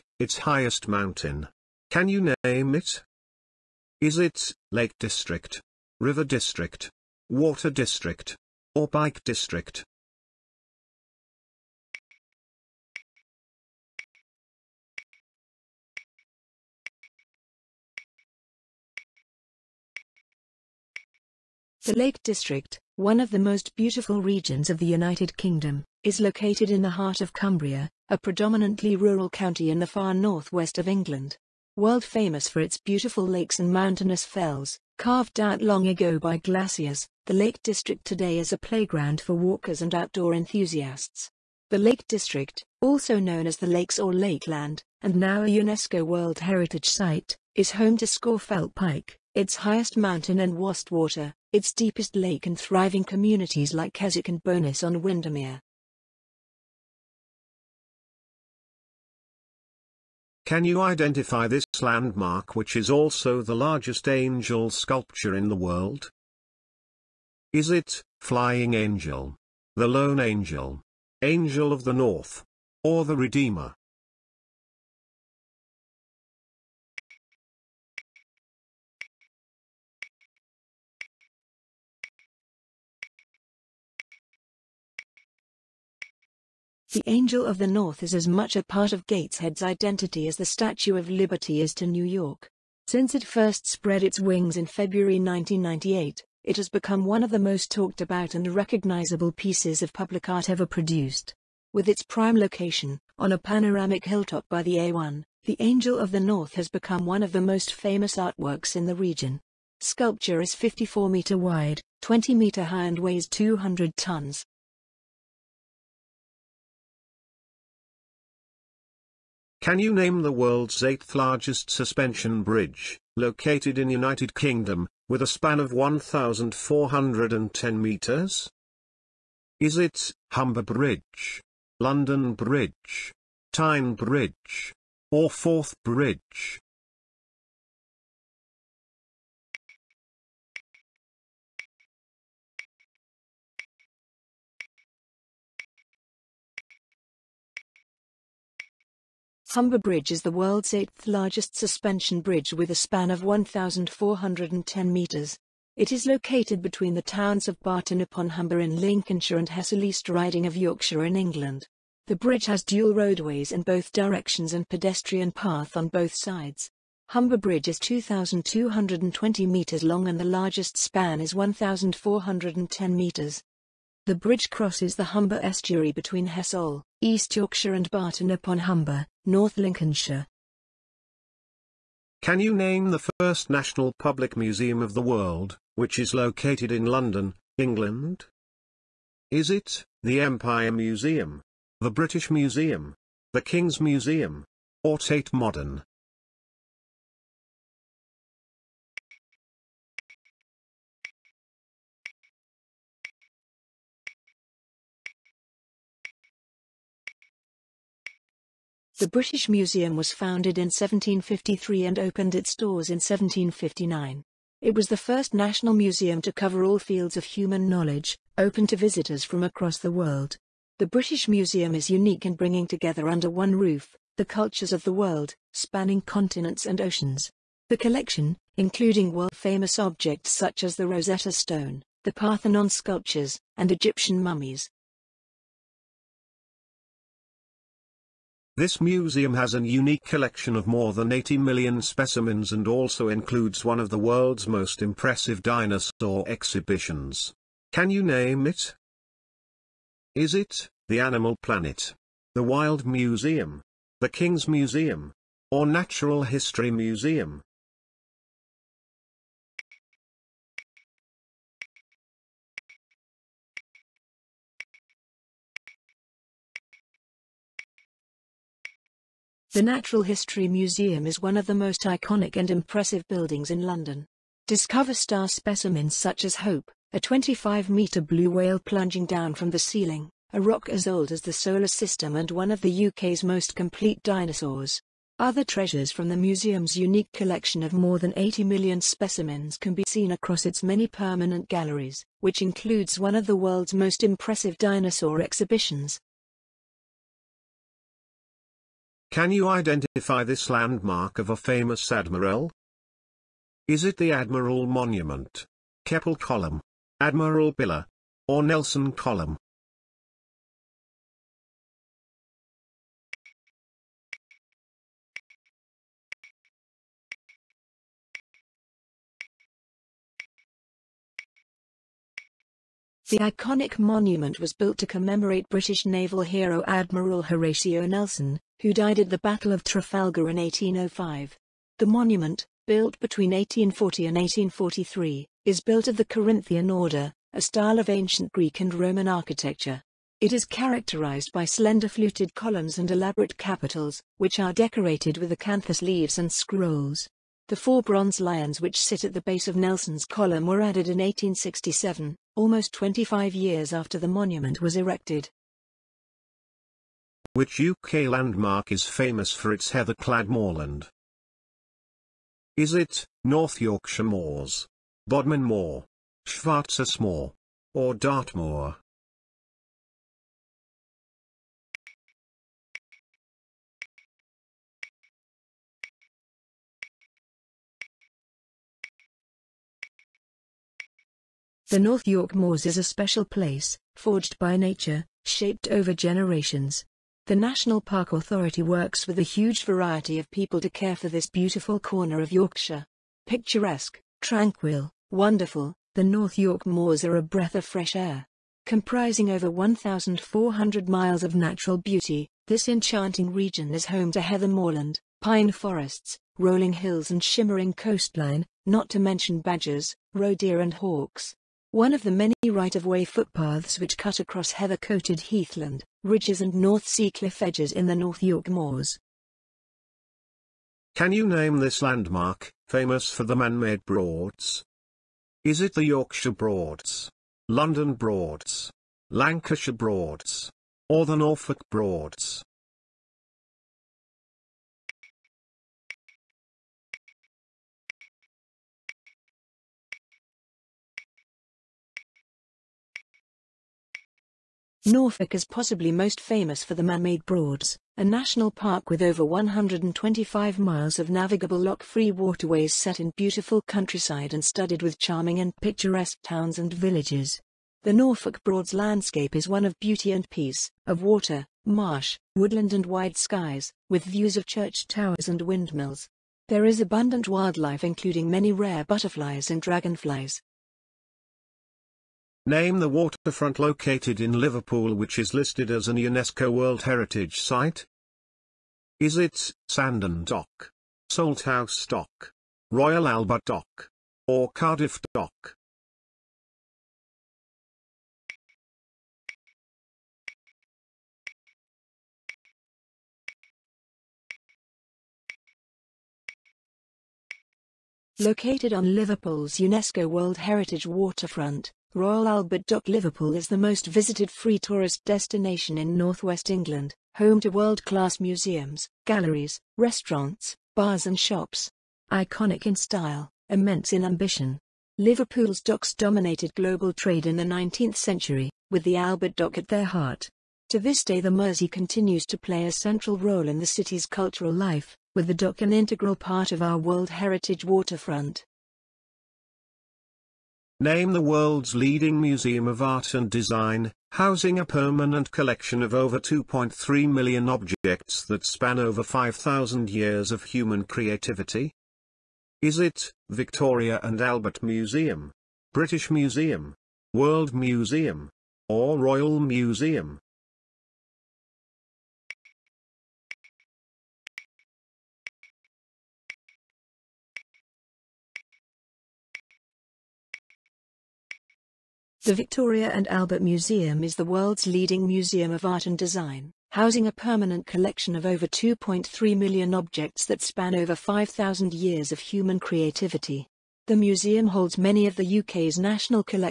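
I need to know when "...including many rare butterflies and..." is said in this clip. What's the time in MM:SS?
07:47.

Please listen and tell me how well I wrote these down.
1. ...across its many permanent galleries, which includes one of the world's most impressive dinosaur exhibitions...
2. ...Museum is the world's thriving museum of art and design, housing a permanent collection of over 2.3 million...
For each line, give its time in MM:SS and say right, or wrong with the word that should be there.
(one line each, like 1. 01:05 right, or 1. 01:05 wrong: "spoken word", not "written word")
1. 04:50 right
2. 09:23 wrong: "leading", not "thriving".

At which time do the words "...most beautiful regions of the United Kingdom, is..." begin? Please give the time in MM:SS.
00:23.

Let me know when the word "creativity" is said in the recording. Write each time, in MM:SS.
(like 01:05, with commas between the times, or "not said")
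09:00, 09:32.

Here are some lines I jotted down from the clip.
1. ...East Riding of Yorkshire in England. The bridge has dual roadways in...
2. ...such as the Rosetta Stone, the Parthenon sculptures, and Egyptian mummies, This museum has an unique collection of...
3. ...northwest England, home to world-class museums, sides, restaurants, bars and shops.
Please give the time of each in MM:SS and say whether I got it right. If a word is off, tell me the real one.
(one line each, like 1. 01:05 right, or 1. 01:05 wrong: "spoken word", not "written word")
1. 02:39 right
2. 03:50 right
3. 08:25 wrong: "galleries", not "sides".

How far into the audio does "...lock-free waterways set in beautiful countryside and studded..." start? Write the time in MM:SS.
07:31.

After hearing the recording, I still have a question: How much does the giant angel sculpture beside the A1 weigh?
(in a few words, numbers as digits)
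200 tons.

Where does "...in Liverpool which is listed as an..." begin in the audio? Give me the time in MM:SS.
07:54.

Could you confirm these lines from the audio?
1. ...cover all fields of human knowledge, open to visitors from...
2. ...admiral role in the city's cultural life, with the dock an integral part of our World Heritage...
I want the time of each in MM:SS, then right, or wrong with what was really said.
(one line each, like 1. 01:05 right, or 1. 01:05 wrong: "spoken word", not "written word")
1. 03:36 right
2. 08:42 wrong: "central", not "admiral".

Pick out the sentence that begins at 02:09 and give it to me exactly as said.
Is it Humber Bridge, London Bridge, Tyne Bridge, or Forth Bridge?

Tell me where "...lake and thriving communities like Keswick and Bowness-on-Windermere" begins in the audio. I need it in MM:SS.
00:52.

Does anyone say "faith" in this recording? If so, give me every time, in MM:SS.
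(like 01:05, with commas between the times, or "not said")
not said.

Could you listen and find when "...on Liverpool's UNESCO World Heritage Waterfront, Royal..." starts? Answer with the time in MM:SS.
08:18.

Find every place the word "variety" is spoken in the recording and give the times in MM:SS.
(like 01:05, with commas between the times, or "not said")
06:29.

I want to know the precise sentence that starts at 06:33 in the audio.
Picturesque, tranquil, wonderful, the North York Moors are a breath of fresh air.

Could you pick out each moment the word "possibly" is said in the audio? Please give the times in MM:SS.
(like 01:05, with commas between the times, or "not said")
07:25.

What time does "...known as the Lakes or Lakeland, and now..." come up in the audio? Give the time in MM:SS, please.
00:43.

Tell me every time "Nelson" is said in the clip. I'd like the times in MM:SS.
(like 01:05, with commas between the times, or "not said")
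05:08, 05:27, 05:49.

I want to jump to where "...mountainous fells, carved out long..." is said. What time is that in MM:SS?
00:33.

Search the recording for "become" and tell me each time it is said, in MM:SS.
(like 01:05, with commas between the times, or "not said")
01:36, 01:46.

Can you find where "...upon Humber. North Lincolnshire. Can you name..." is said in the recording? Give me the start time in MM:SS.
02:58.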